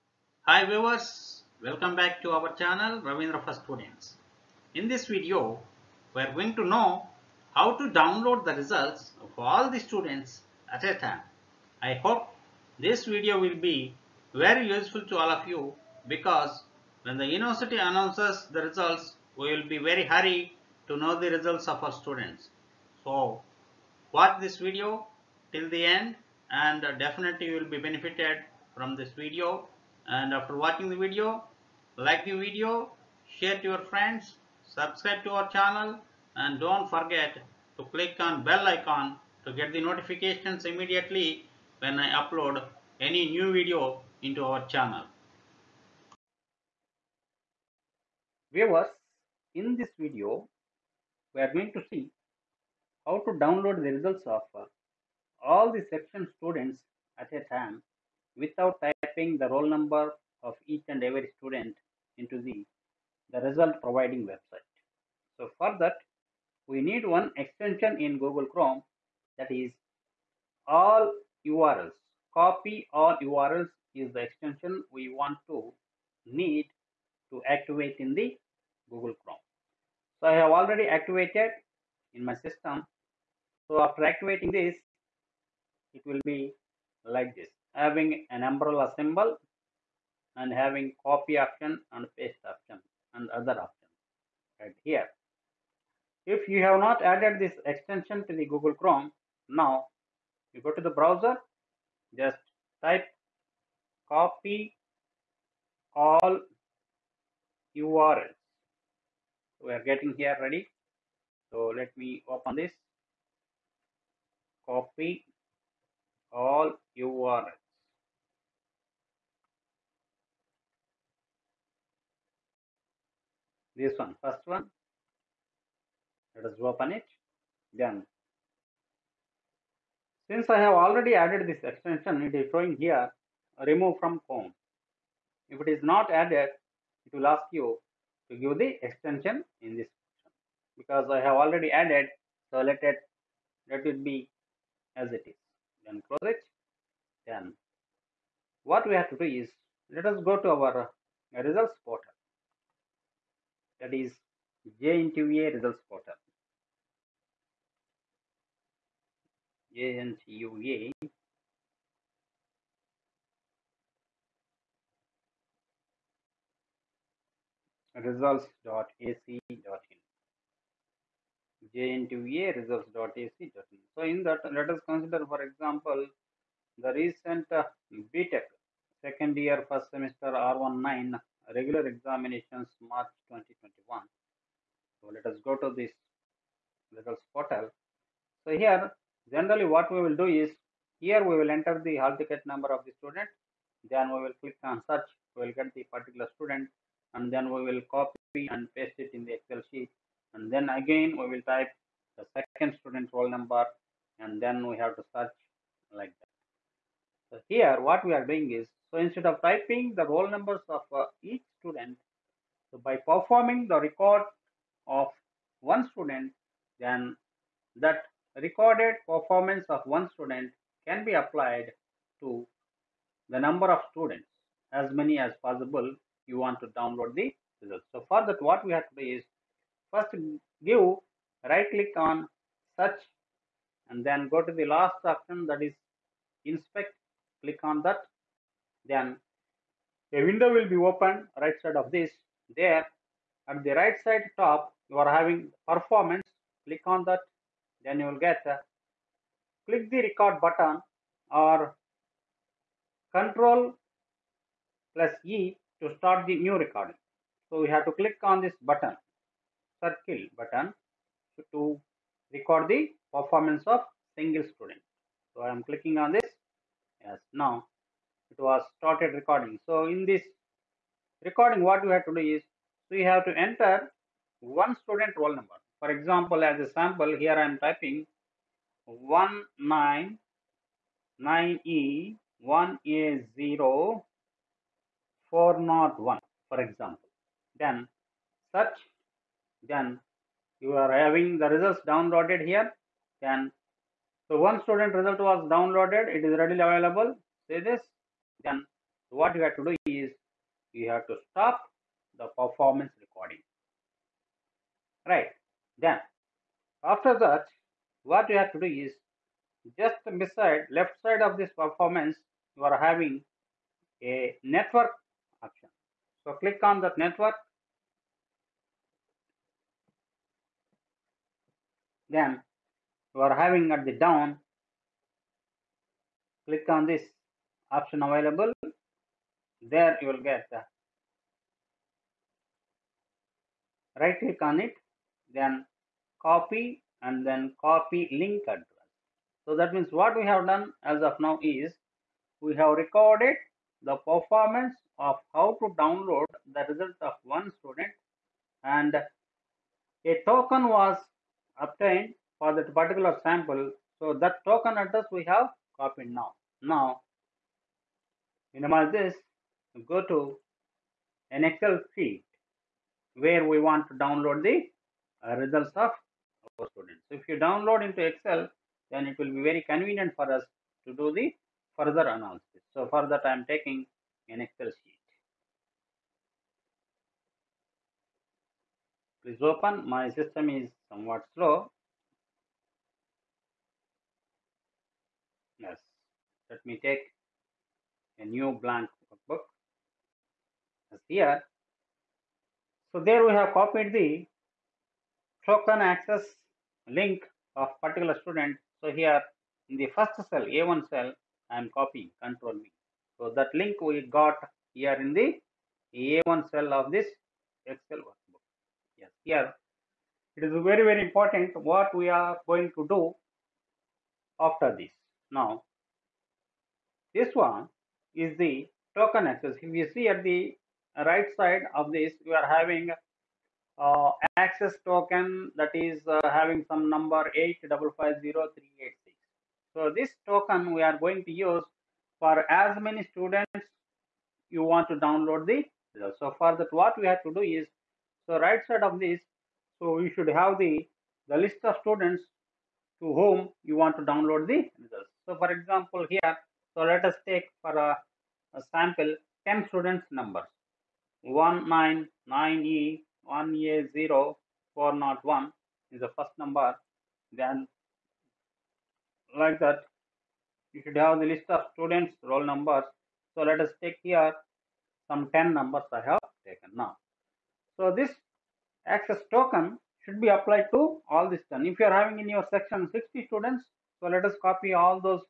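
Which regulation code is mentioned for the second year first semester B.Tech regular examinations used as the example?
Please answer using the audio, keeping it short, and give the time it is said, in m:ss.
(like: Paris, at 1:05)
R19, at 3:00.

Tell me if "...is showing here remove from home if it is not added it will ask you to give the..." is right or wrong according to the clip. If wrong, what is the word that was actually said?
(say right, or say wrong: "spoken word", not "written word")
right.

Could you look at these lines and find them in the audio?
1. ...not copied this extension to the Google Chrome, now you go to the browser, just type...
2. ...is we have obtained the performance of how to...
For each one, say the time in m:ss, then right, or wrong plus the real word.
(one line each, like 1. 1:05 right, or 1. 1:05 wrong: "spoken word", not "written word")
1. 1:36 wrong: "added", not "copied"
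2. 5:41 wrong: "recorded", not "obtained".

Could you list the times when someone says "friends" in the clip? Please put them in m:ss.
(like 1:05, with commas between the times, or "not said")
0:33.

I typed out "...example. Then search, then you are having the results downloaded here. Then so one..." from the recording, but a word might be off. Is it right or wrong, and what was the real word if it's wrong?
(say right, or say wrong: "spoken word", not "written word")
right.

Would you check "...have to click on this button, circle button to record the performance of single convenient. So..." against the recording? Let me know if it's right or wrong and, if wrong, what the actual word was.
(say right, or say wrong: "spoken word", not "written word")
wrong: "student", not "convenient".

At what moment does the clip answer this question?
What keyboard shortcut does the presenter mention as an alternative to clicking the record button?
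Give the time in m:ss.
4:13.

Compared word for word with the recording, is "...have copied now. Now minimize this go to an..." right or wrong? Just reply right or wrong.
right.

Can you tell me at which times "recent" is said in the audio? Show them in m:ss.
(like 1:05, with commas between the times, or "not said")
2:56.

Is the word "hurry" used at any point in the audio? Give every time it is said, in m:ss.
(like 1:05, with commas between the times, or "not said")
0:20.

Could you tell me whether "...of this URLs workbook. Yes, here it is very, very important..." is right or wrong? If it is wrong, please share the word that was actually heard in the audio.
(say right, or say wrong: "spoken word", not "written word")
wrong: "Excel", not "URLs".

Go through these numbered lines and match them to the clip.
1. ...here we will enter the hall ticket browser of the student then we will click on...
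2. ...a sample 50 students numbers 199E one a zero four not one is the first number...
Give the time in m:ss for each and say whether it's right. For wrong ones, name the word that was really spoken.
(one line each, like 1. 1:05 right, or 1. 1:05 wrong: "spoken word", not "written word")
1. 3:11 wrong: "number", not "browser"
2. 7:28 wrong: "10", not "50".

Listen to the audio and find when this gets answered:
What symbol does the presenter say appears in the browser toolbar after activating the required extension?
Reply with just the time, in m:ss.
1:28.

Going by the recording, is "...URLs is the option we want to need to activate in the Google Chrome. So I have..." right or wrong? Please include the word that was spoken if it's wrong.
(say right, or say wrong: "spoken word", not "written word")
wrong: "extension", not "option".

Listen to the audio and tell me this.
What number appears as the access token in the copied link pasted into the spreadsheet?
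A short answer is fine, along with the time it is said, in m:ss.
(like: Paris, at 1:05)
8550386, at 7:07.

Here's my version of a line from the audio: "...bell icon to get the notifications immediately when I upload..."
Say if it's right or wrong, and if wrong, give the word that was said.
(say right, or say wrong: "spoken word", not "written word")
right.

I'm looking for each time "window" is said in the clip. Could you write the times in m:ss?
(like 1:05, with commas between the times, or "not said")
4:00.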